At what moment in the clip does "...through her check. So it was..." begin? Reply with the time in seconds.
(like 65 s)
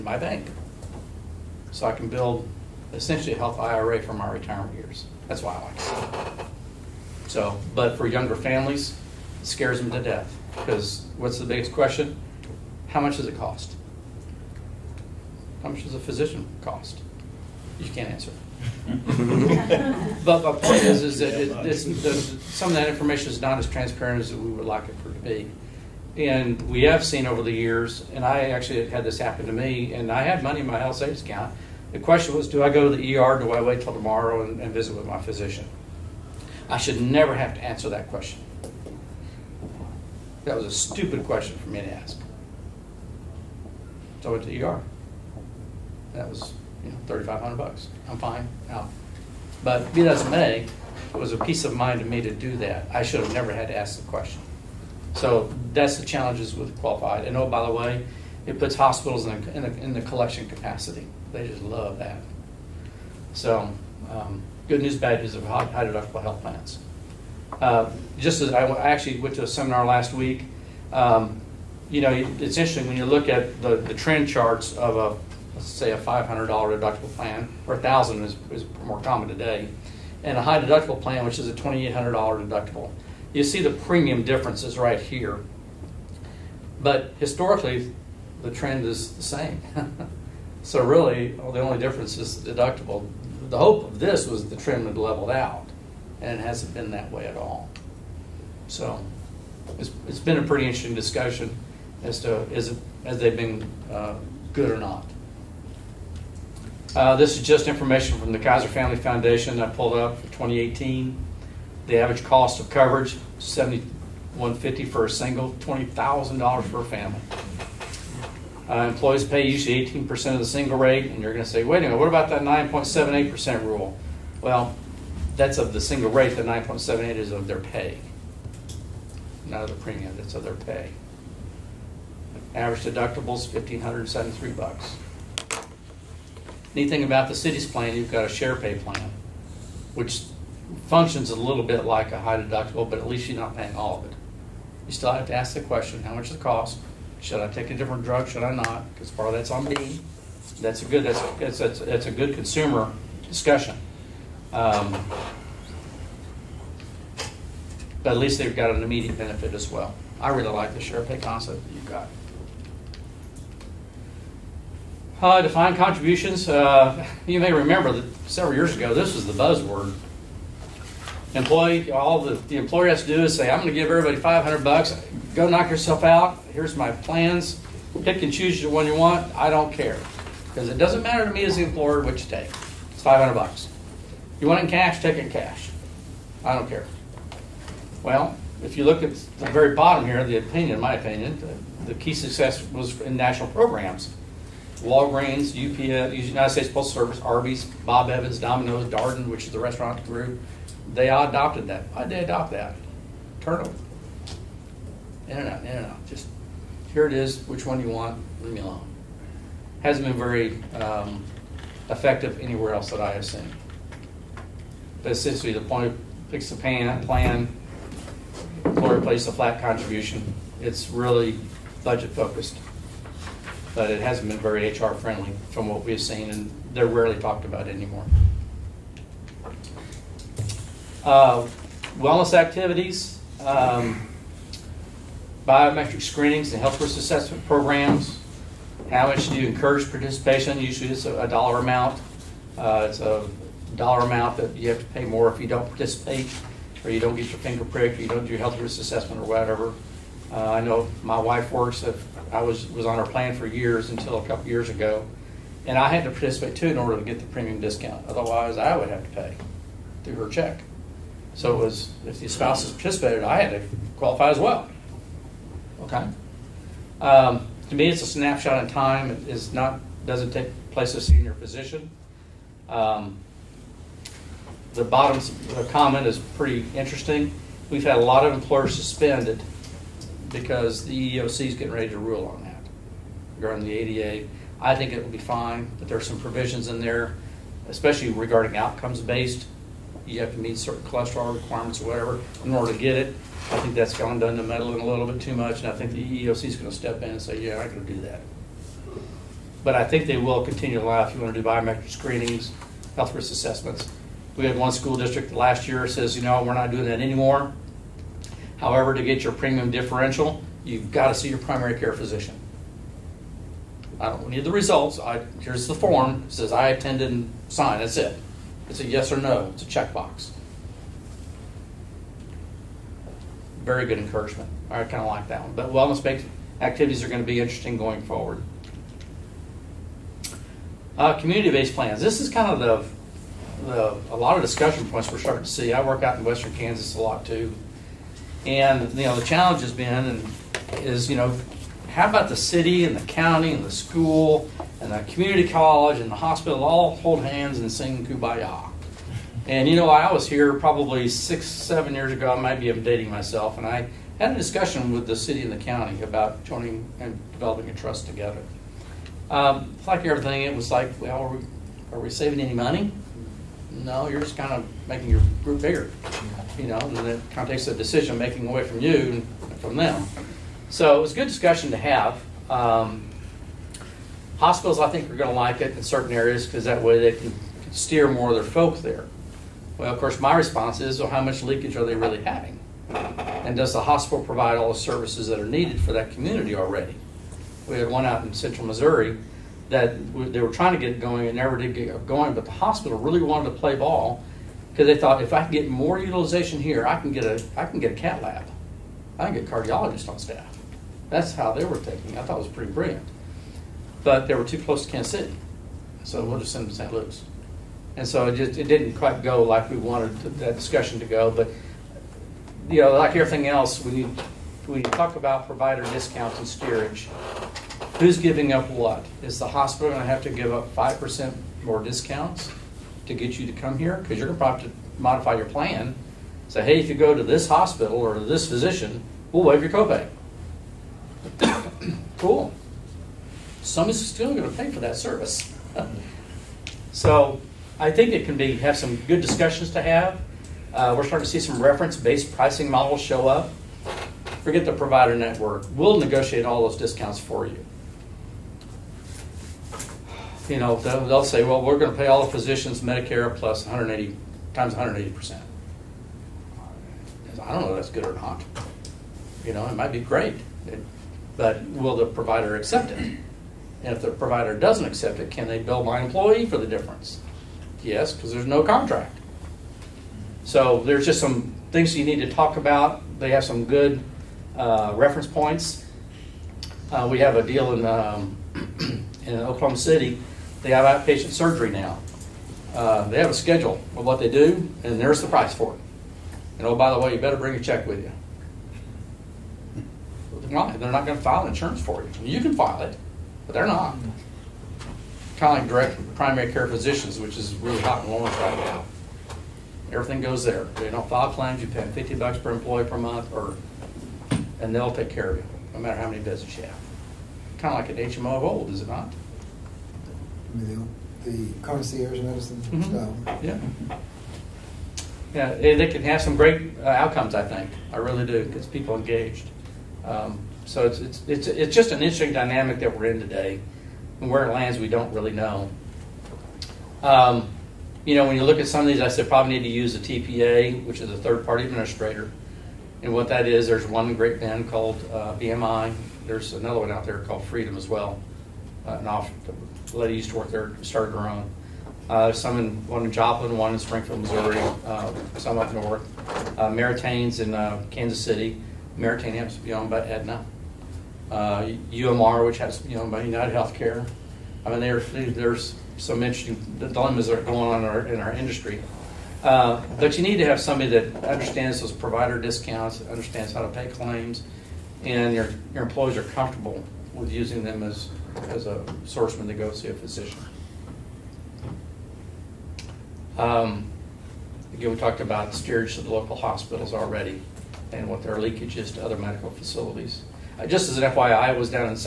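260 s.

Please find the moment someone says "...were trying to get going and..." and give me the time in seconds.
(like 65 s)
390 s.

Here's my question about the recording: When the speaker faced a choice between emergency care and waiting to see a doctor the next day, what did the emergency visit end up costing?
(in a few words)
$3,500.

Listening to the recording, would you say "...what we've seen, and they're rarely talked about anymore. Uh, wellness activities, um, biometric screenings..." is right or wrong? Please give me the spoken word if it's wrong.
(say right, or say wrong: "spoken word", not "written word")
right.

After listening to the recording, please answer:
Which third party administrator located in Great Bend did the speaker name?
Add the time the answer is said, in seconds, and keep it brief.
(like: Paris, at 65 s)
BMI, at 535 s.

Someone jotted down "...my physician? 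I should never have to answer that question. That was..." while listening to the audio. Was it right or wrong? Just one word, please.
right.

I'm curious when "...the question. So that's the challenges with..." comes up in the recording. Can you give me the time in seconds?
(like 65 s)
54 s.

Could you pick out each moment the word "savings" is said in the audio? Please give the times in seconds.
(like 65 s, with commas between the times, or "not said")
30 s, 362 s.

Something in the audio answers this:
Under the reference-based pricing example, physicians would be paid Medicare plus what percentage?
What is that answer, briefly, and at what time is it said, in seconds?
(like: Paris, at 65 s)
180%, at 454 s.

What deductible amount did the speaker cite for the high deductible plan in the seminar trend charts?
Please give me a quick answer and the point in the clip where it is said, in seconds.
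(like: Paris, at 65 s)
$2,800, at 81 s.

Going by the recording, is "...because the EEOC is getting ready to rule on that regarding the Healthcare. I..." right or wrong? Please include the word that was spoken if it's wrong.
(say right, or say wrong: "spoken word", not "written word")
wrong: "ADA", not "Healthcare".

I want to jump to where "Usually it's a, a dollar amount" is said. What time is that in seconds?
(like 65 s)
240 s.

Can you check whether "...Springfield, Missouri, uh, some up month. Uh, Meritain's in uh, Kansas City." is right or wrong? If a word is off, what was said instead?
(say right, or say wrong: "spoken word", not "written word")
wrong: "north", not "month".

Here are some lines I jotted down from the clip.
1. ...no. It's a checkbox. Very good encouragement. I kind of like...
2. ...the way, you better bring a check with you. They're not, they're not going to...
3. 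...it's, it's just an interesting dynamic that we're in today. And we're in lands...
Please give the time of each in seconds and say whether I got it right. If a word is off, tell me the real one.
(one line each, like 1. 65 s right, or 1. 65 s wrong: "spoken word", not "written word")
1. 319 s right
2. 486 s right
3. 521 s right.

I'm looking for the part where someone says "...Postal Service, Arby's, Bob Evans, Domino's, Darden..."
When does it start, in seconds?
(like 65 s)
196 s.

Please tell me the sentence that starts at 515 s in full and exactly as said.
Yeah, they can have some great uh, outcomes, I think.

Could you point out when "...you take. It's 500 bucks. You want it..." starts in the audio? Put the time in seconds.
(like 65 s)
182 s.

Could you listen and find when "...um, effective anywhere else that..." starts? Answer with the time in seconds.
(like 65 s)
210 s.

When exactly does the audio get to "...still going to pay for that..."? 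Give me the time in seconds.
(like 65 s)
434 s.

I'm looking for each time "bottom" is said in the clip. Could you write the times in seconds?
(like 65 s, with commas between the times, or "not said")
189 s, 274 s.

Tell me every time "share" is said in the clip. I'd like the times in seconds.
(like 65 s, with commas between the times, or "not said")
138 s, 160 s.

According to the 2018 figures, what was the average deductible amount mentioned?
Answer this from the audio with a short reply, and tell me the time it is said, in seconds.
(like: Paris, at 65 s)
$1,573, at 133 s.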